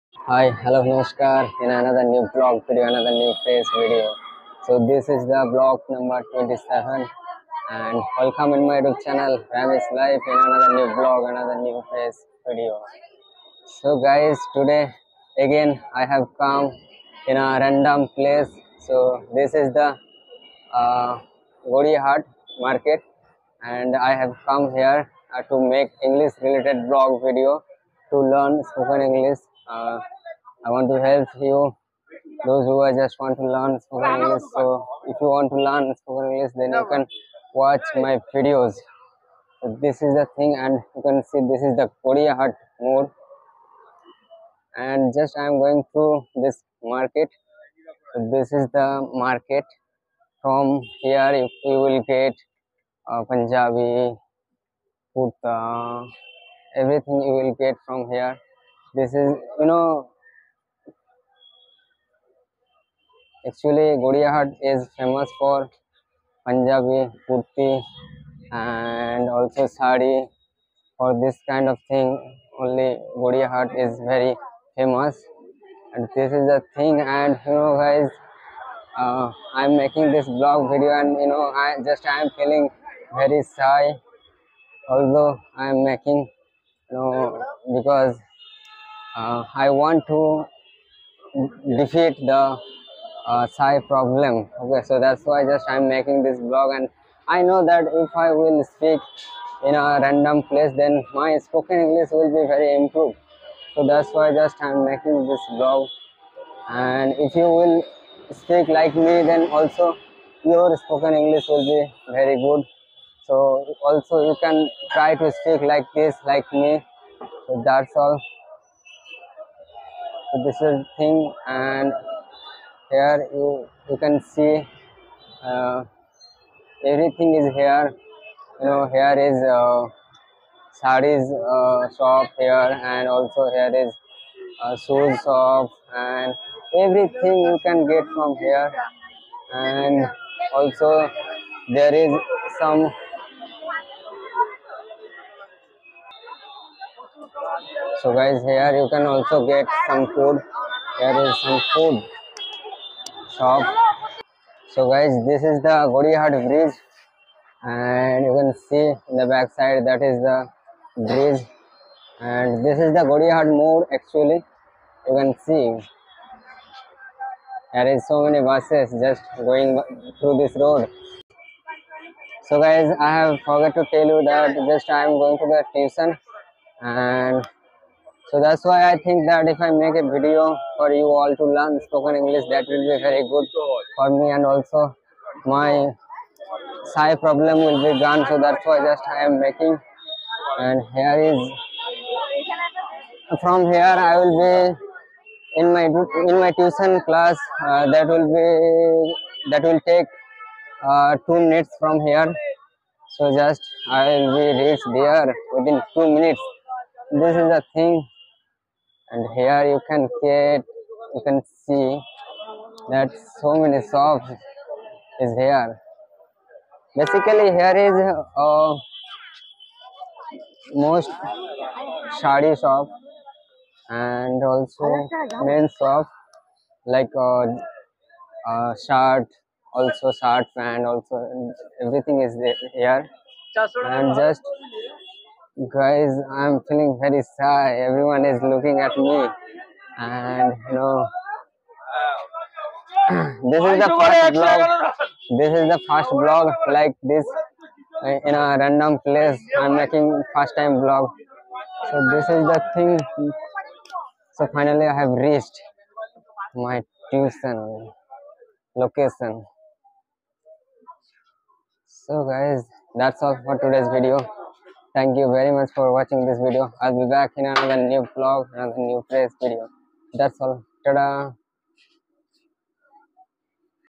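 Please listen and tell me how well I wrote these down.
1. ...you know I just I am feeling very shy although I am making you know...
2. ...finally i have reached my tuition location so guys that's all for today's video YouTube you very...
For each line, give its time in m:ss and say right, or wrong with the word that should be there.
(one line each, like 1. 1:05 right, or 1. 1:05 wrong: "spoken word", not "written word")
1. 1:21 right
2. 4:14 wrong: "Thank", not "YouTube".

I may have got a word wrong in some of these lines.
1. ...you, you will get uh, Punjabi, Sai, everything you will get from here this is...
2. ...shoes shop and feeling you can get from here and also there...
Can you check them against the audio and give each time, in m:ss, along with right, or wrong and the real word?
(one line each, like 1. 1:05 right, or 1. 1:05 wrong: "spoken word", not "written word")
1. 0:51 wrong: "Puta", not "Sai"
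2. 2:14 wrong: "everything", not "feeling".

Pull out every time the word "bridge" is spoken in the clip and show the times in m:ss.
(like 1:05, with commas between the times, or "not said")
2:36, 2:41.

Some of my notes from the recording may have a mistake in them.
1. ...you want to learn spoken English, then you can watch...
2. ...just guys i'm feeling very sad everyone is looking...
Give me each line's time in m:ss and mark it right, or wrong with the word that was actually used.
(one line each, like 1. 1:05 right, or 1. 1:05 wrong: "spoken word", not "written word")
1. 0:35 right
2. 3:54 right.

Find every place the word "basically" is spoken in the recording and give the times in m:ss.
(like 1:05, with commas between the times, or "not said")
3:36.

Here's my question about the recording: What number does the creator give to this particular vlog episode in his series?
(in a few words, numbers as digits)
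27.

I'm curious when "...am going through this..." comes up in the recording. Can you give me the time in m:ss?
0:45.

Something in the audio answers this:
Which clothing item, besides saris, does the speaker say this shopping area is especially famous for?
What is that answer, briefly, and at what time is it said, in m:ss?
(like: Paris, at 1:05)
Punjabi kurti, at 1:06.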